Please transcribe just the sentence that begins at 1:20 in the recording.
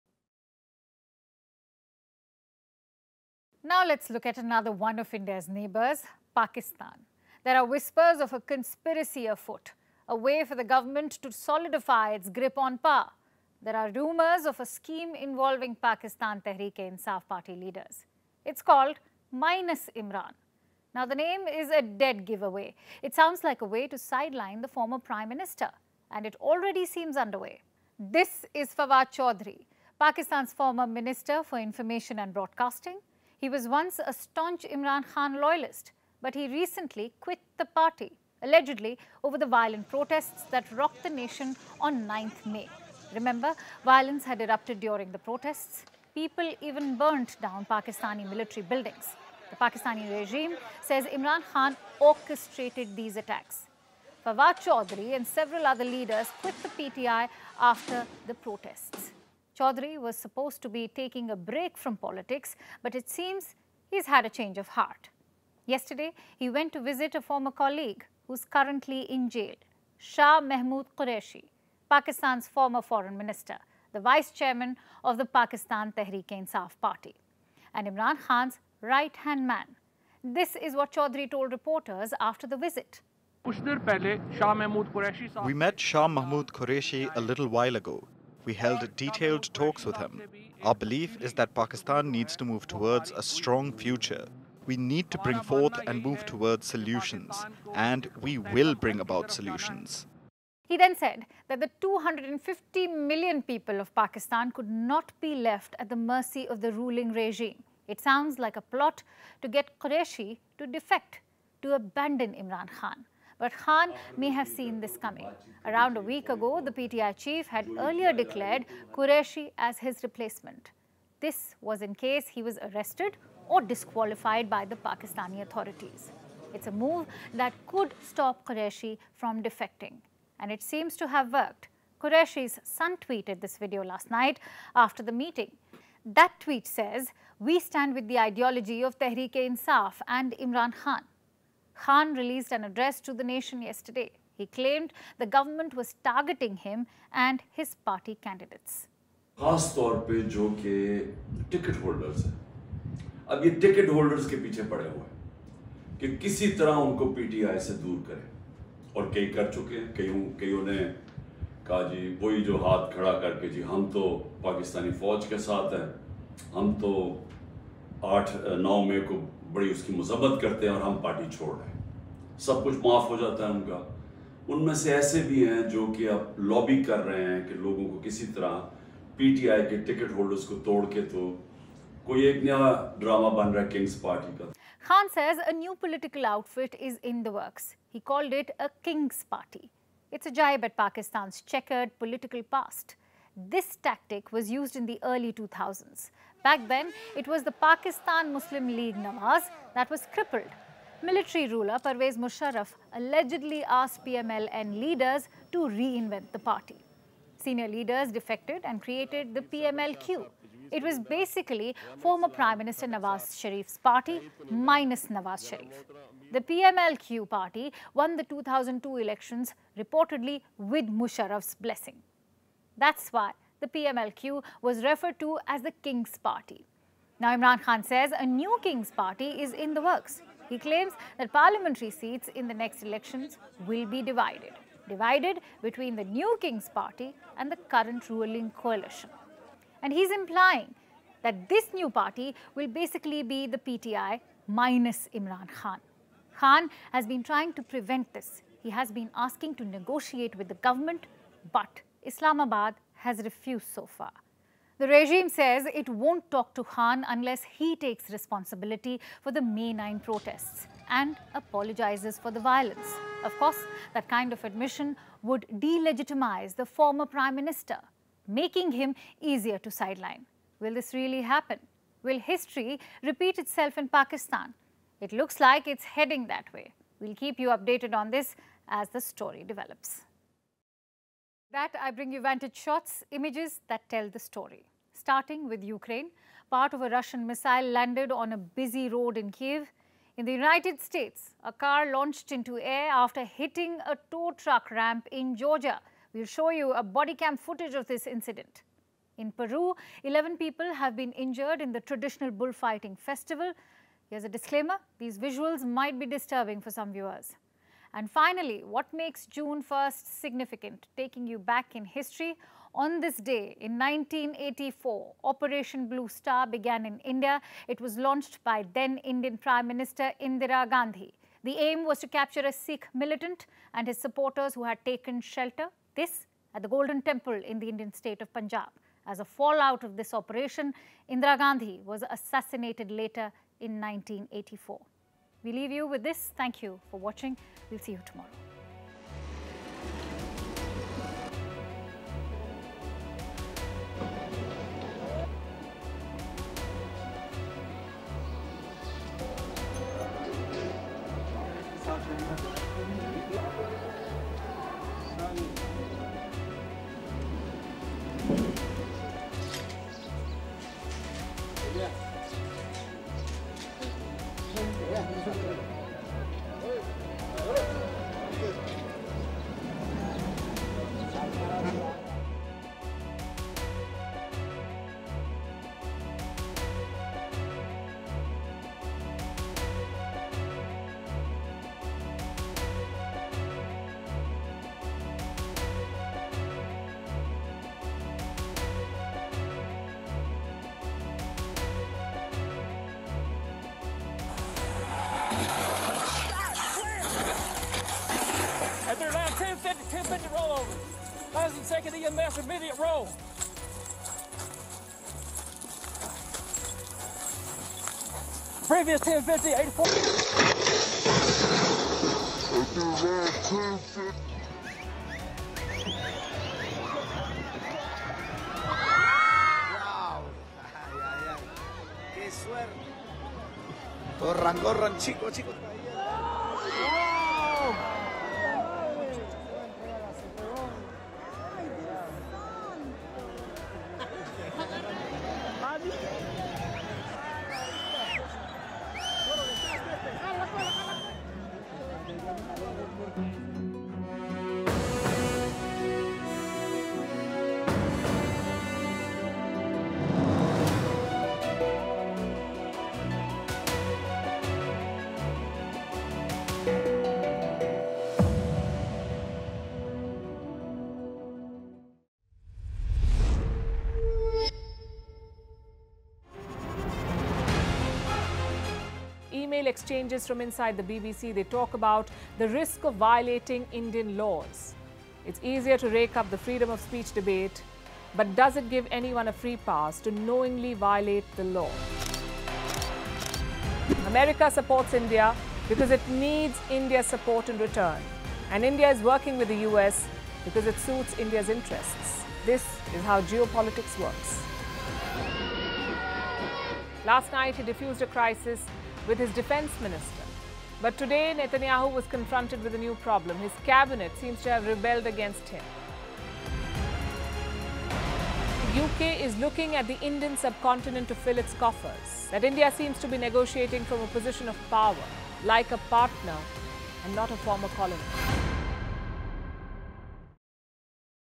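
This is what Chaudhary told reporters after the visit.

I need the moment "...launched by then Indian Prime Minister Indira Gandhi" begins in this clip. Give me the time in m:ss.
5:17.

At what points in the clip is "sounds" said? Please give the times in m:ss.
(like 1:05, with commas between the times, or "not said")
0:23, 1:48.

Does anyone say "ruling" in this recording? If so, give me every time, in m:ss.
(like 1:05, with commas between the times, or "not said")
1:46, 3:58.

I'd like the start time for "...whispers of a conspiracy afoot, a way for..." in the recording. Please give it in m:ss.
0:07.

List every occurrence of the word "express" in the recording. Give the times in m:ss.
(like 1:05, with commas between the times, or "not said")
not said.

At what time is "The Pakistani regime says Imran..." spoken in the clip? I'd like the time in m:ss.
0:49.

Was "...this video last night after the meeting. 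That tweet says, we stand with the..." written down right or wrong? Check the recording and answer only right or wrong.
right.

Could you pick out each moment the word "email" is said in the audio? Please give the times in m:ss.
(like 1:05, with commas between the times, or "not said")
7:49.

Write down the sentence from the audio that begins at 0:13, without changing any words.
There are rumours of a scheme involving Pakistan Tehreek-e-Insaf party leaders.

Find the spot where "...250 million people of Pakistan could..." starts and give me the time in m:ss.
1:41.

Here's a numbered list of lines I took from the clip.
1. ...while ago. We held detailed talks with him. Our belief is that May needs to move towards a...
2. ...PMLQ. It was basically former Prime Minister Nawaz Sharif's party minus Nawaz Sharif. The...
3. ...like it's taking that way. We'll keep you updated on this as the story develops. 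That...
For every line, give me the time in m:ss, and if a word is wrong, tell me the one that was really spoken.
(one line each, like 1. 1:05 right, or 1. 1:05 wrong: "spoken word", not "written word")
1. 1:27 wrong: "Pakistan", not "May"
2. 3:29 right
3. 4:35 wrong: "heading", not "taking".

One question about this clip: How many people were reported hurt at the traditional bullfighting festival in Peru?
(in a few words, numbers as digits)
11.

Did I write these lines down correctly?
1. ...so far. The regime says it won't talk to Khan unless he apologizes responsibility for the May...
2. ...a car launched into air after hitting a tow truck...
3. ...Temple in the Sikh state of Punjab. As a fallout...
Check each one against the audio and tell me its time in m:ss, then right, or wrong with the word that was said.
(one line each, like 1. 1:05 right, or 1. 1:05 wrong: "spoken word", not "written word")
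1. 4:13 wrong: "takes", not "apologizes"
2. 4:51 right
3. 5:27 wrong: "Indian", not "Sikh".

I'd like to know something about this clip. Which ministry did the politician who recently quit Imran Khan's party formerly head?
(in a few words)
Information and Broadcasting.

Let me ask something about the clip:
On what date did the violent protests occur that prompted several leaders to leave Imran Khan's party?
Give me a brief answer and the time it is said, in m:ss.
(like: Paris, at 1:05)
9th May, at 0:42.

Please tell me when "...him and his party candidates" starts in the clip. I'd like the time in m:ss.
2:26.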